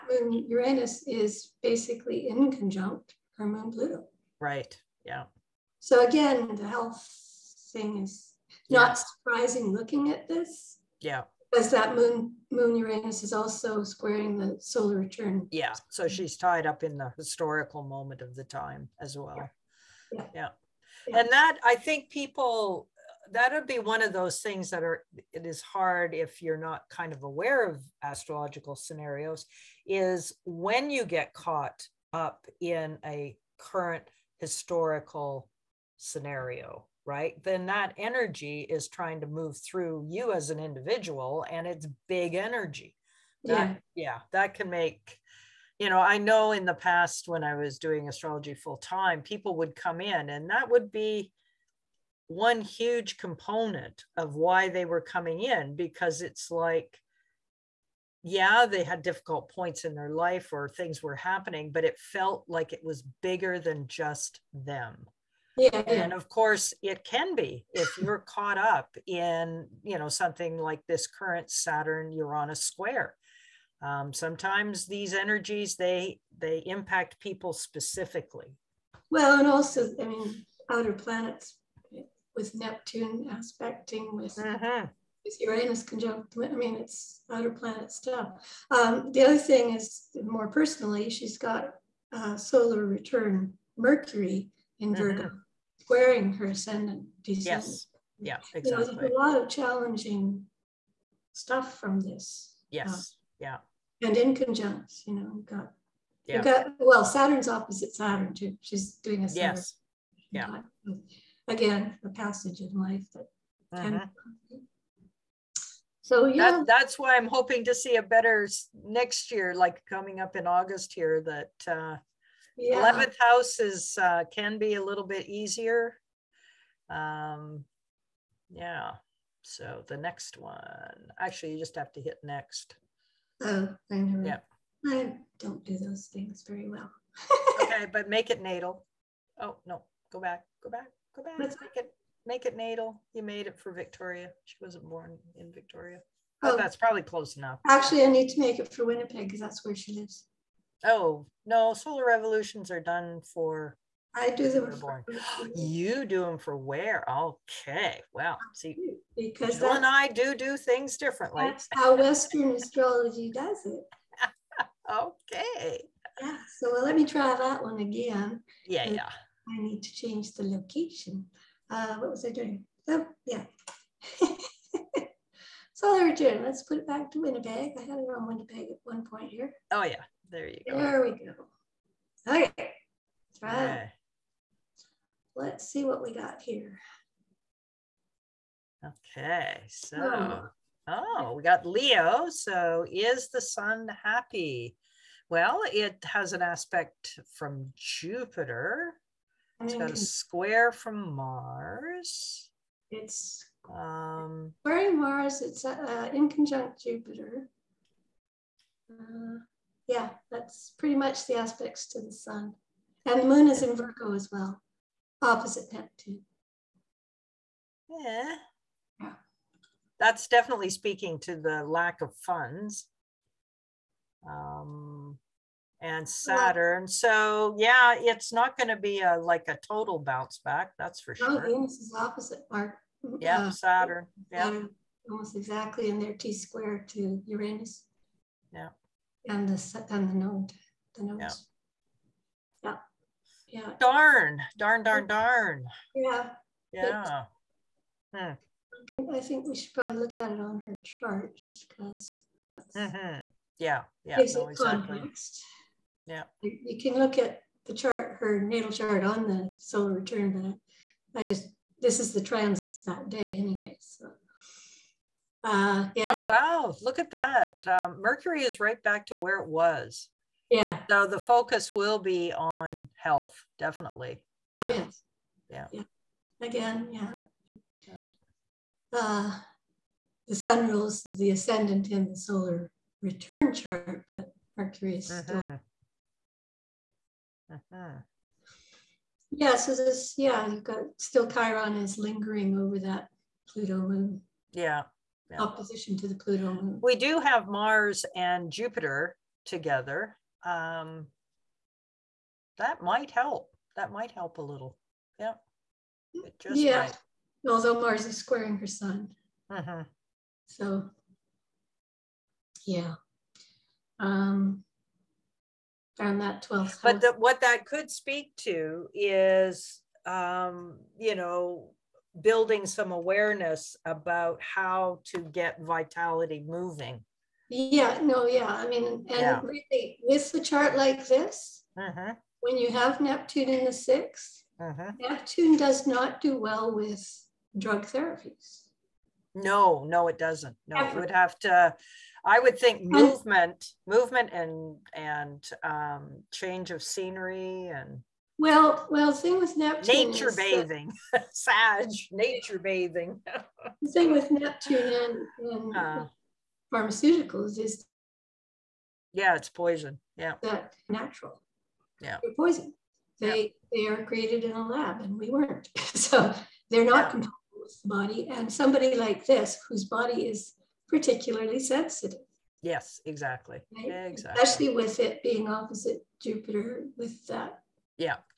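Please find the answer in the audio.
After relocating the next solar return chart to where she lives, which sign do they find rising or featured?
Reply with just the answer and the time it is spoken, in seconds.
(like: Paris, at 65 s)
Leo, at 191 s.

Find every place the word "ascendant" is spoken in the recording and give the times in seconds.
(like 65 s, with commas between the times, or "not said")
96 s, 281 s.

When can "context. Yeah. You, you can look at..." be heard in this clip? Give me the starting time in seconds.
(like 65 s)
254 s.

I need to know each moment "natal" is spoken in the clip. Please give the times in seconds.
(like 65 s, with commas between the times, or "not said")
138 s, 142 s, 258 s.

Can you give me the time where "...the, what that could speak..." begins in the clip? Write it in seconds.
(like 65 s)
317 s.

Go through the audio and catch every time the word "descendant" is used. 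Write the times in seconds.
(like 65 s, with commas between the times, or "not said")
97 s.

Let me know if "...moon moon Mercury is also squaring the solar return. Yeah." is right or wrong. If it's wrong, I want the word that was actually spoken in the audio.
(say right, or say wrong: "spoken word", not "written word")
wrong: "Uranus", not "Mercury".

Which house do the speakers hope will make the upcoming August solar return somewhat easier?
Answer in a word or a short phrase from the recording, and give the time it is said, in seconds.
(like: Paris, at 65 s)
11th house, at 122 s.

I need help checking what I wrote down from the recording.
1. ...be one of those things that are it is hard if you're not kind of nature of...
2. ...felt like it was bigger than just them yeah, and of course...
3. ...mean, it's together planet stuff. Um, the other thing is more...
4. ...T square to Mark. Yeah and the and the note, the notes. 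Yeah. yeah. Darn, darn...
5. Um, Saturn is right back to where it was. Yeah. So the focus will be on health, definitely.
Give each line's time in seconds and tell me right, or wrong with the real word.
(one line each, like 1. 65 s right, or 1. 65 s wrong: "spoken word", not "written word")
1. 23 s wrong: "aware", not "nature"
2. 61 s right
3. 86 s wrong: "outer", not "together"
4. 236 s wrong: "Uranus", not "Mark"
5. 267 s wrong: "Mercury", not "Saturn".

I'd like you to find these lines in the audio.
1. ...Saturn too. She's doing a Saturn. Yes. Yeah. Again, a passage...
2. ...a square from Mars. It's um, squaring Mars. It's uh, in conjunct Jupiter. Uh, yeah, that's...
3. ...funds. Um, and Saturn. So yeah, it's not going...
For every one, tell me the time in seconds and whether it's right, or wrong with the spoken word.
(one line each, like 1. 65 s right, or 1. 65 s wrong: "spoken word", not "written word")
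1. 107 s right
2. 199 s right
3. 222 s right.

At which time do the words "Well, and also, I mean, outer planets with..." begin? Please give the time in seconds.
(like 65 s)
79 s.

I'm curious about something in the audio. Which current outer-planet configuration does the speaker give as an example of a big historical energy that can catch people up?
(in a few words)
Saturn Uranus square.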